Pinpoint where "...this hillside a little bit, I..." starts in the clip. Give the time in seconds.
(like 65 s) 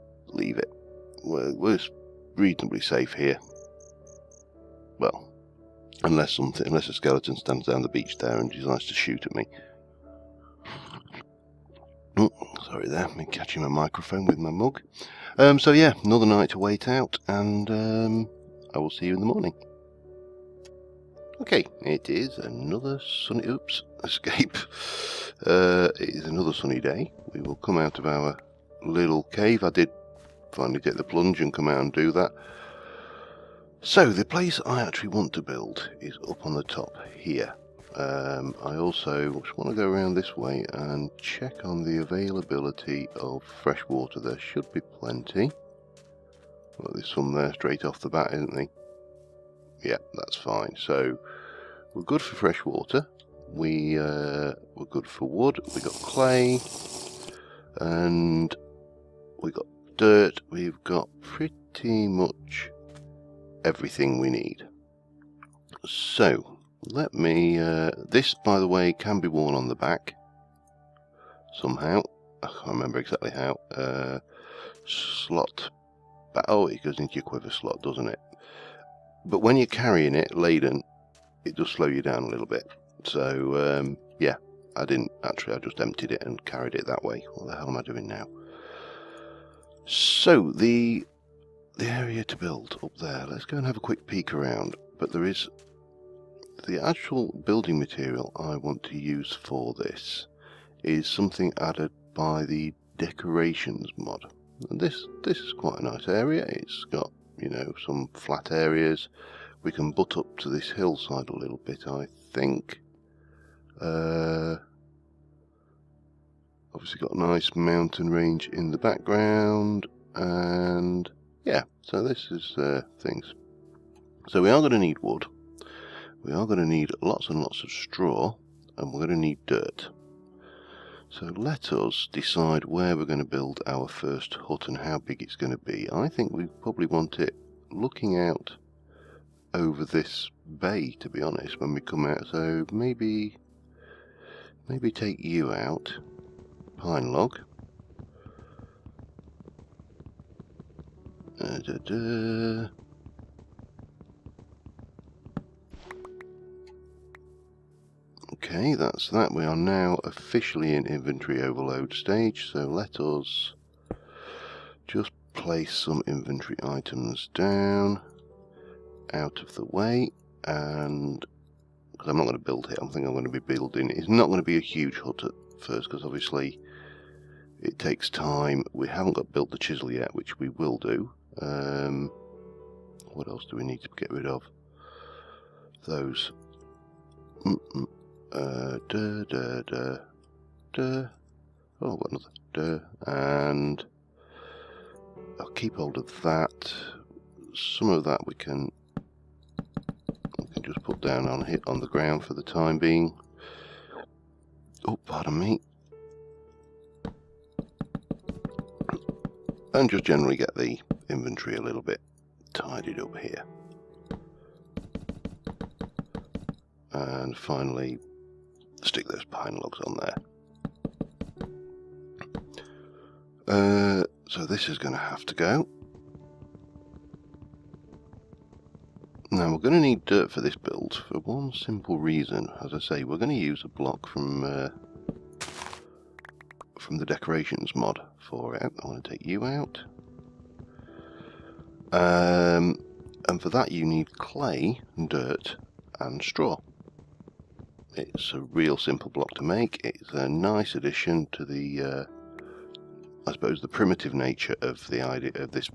110 s.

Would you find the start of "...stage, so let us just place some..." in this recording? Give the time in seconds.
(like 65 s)
161 s.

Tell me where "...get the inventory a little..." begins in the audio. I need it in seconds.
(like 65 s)
210 s.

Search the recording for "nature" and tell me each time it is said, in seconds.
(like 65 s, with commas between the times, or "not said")
254 s.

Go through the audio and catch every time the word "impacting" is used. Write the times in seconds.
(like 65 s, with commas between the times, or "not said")
not said.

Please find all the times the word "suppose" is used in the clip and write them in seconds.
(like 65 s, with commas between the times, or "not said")
253 s.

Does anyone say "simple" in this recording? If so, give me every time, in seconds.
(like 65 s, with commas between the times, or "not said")
231 s, 248 s.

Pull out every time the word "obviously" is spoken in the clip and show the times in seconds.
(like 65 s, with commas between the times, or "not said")
116 s, 176 s.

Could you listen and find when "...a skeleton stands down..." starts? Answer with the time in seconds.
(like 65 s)
6 s.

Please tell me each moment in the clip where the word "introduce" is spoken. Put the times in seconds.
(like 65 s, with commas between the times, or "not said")
not said.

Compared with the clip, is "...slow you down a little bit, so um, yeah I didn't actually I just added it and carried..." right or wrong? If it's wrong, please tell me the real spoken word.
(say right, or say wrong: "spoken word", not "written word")
wrong: "emptied", not "added".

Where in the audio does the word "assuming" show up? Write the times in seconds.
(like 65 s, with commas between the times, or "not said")
not said.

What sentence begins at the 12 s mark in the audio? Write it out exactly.
Sorry there, me catching my microphone with my mug.